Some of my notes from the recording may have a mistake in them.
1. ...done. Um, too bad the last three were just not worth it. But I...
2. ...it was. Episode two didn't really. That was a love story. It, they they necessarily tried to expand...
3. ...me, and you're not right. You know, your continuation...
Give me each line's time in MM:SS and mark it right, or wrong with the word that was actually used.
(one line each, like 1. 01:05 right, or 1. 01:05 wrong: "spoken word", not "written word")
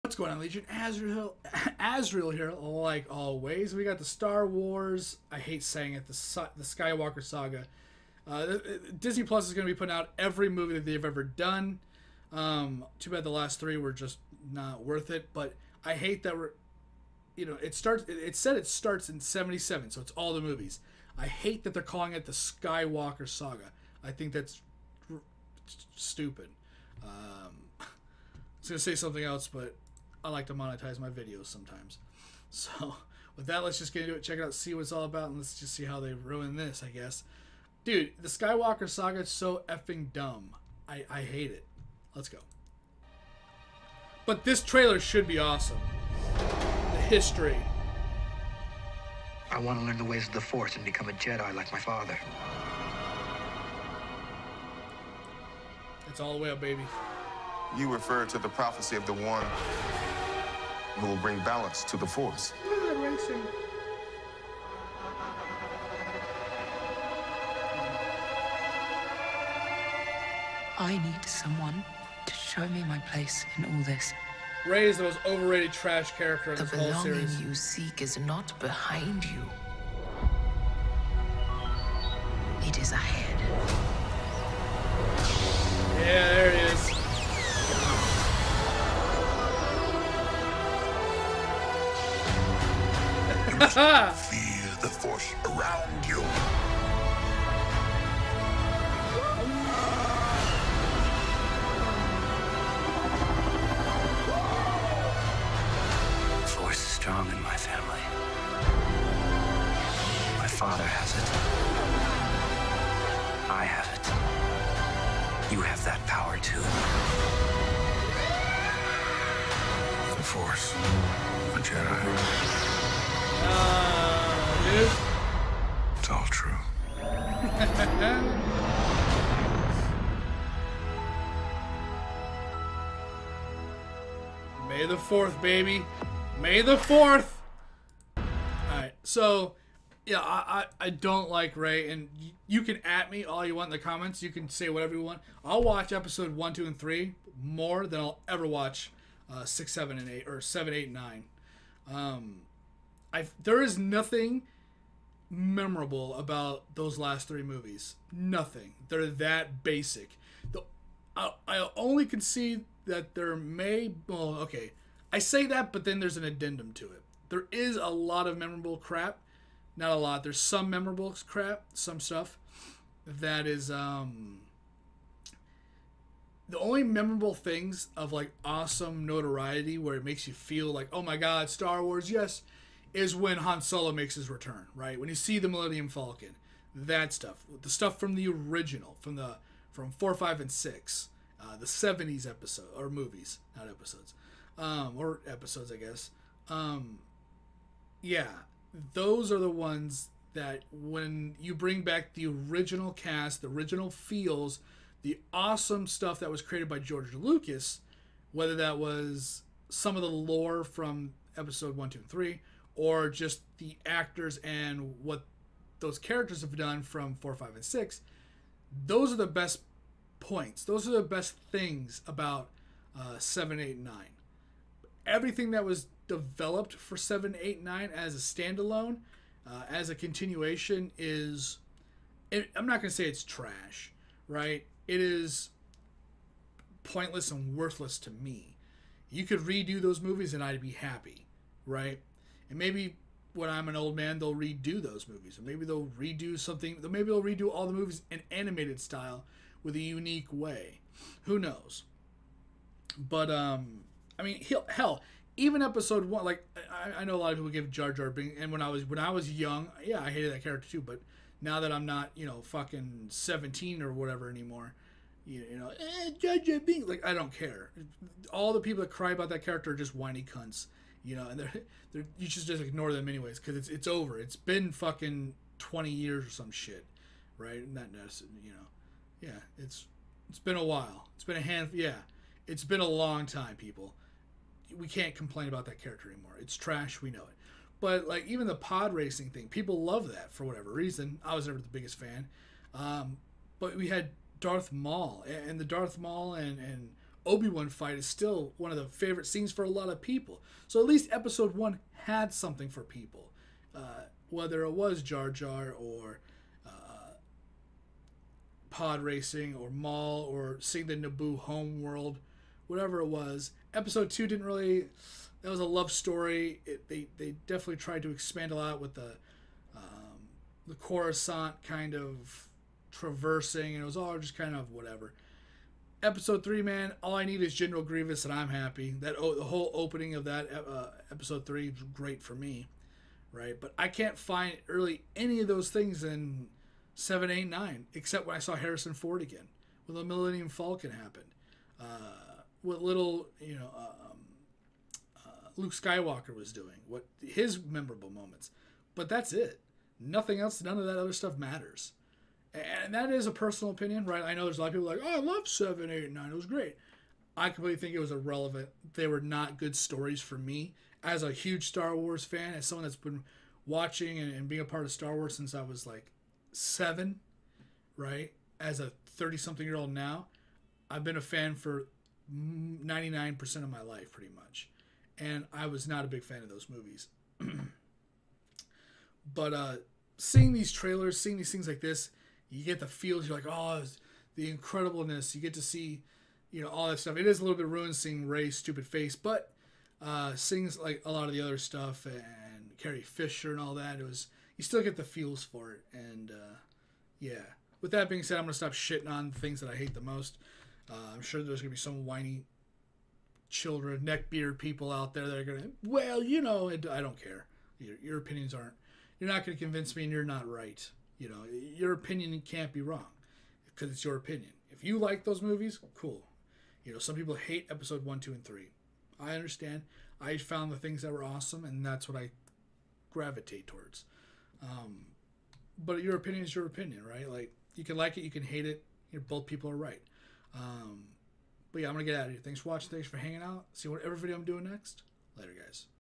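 1. 00:11 right
2. 05:13 wrong: "definitely", not "necessarily"
3. 06:49 wrong: "opinion", not "continuation".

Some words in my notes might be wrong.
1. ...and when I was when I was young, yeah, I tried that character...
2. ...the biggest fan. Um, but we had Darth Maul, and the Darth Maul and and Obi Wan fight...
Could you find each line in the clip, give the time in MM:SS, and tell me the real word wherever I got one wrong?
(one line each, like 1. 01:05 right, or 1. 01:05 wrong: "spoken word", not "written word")
1. 04:18 wrong: "hated", not "tried"
2. 04:51 right.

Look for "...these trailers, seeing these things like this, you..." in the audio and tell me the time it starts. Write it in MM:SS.
06:20.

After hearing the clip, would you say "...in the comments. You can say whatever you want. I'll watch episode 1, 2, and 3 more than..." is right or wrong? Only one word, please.
right.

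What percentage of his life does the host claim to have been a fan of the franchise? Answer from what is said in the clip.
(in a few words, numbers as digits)
99%.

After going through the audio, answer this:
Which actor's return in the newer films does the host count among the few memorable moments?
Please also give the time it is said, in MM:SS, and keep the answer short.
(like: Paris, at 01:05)
Harrison Ford, at 05:38.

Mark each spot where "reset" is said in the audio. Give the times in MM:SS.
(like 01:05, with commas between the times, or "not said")
not said.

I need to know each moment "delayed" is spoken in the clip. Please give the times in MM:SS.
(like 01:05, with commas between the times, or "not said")
not said.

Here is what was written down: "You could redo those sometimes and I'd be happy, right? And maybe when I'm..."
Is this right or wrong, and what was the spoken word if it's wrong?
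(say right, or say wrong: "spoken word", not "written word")
wrong: "movies", not "sometimes".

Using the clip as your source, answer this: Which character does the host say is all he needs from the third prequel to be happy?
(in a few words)
General Grievous.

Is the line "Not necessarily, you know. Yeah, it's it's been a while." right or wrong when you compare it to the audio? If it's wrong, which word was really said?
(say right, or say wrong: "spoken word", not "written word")
right.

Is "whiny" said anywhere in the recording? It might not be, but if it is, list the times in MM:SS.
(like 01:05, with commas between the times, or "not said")
04:29, 06:42.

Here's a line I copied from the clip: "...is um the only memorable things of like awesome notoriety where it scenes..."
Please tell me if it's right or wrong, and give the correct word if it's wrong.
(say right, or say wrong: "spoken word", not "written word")
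wrong: "makes", not "scenes".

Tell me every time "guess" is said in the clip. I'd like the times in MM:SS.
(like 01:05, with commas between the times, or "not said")
00:36, 03:15.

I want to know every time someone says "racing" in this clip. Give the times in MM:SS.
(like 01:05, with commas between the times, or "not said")
04:48, 05:09.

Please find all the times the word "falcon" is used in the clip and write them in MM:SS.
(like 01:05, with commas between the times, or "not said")
03:05, 05:40.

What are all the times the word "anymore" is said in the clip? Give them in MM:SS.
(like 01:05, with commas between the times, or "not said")
04:24, 04:46.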